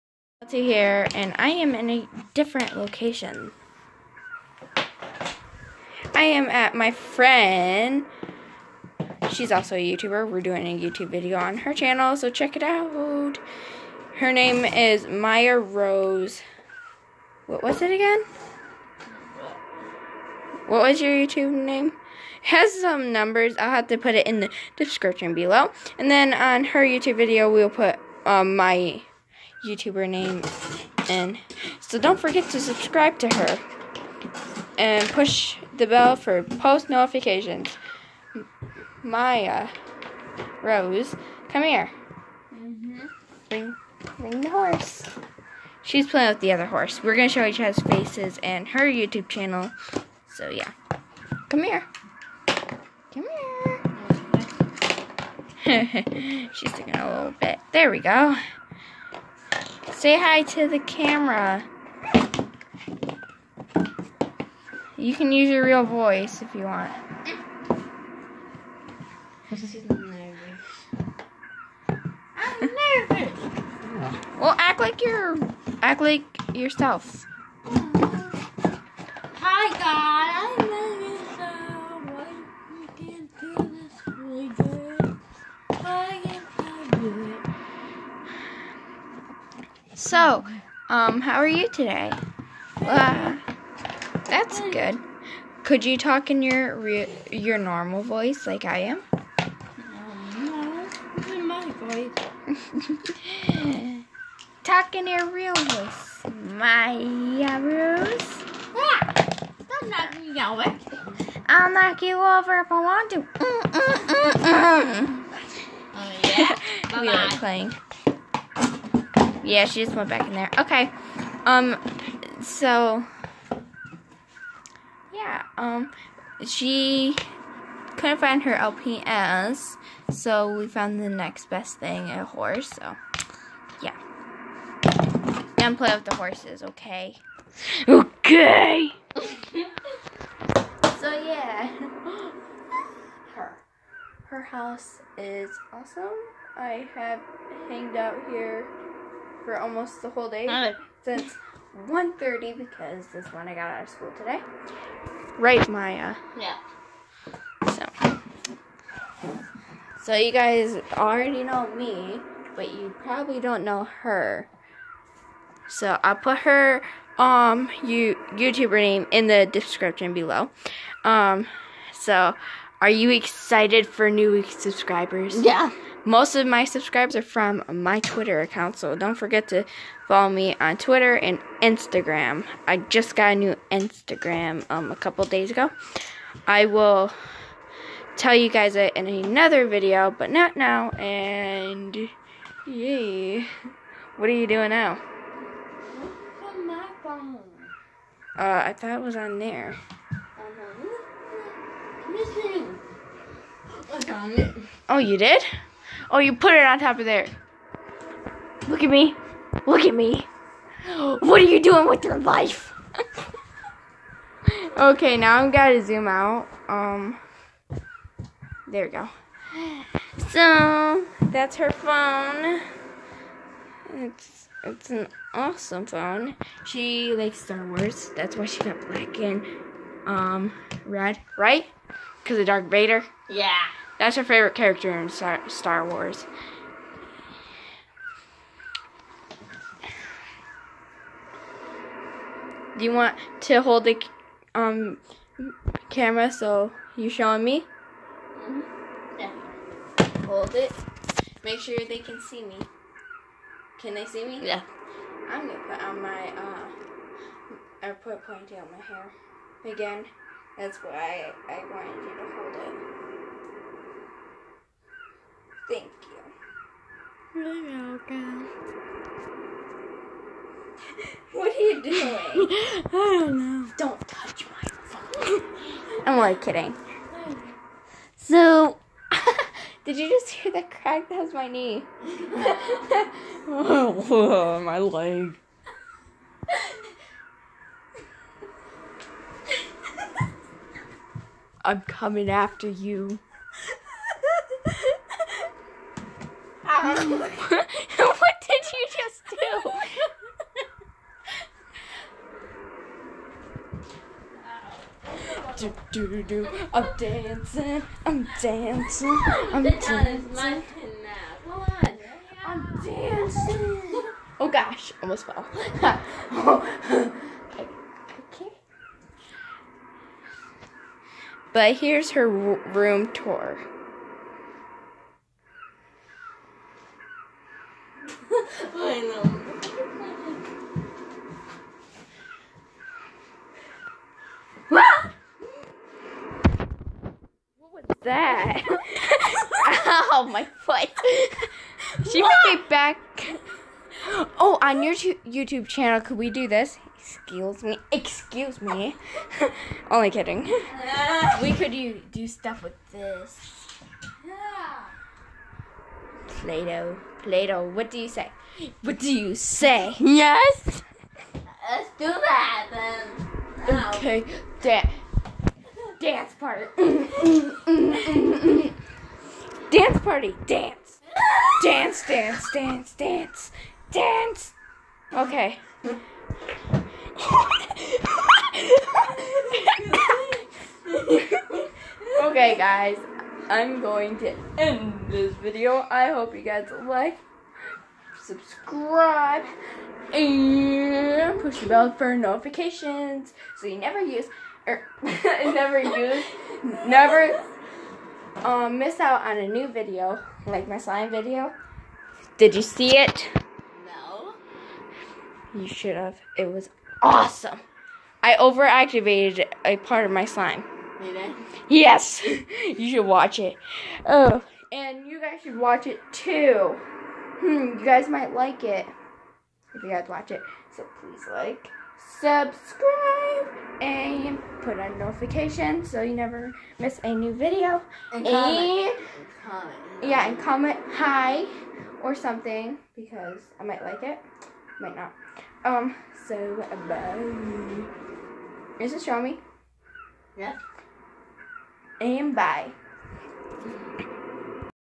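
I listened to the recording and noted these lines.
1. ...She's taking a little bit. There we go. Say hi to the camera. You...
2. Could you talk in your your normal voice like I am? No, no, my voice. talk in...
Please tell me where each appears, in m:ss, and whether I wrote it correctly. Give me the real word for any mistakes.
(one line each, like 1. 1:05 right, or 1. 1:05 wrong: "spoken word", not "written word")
1. 0:56 right
2. 1:35 right.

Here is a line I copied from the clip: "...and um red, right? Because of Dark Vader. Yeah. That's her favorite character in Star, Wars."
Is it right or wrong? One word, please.
right.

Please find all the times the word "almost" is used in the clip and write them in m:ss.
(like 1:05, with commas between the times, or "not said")
2:29, 5:15.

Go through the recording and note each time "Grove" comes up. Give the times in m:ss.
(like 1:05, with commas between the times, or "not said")
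not said.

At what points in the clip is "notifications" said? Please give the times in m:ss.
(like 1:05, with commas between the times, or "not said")
0:36, 6:32, 7:04.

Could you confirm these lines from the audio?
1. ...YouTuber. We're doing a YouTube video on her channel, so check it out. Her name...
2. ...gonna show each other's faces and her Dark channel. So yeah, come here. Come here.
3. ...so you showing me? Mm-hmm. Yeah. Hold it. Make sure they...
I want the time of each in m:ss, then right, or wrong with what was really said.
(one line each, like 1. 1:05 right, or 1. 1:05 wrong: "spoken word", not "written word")
1. 0:09 right
2. 0:47 wrong: "YouTube", not "Dark"
3. 4:06 right.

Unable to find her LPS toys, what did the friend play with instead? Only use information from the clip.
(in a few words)
A horse.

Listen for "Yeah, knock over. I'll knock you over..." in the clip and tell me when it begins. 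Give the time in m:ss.
1:48.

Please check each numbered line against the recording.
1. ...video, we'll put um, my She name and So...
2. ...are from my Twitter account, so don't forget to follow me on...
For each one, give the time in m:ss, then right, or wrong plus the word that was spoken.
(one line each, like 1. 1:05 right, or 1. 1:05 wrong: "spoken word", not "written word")
1. 0:27 wrong: "YouTuber", not "She"
2. 2:57 right.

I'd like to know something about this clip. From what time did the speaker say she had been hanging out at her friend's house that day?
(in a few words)
1.30.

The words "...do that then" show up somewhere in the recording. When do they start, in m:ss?
6:01.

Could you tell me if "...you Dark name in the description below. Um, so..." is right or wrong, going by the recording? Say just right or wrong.
wrong.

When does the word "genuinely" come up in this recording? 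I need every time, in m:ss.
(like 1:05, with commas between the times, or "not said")
not said.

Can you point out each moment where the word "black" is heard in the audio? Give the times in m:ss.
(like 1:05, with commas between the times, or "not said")
3:48.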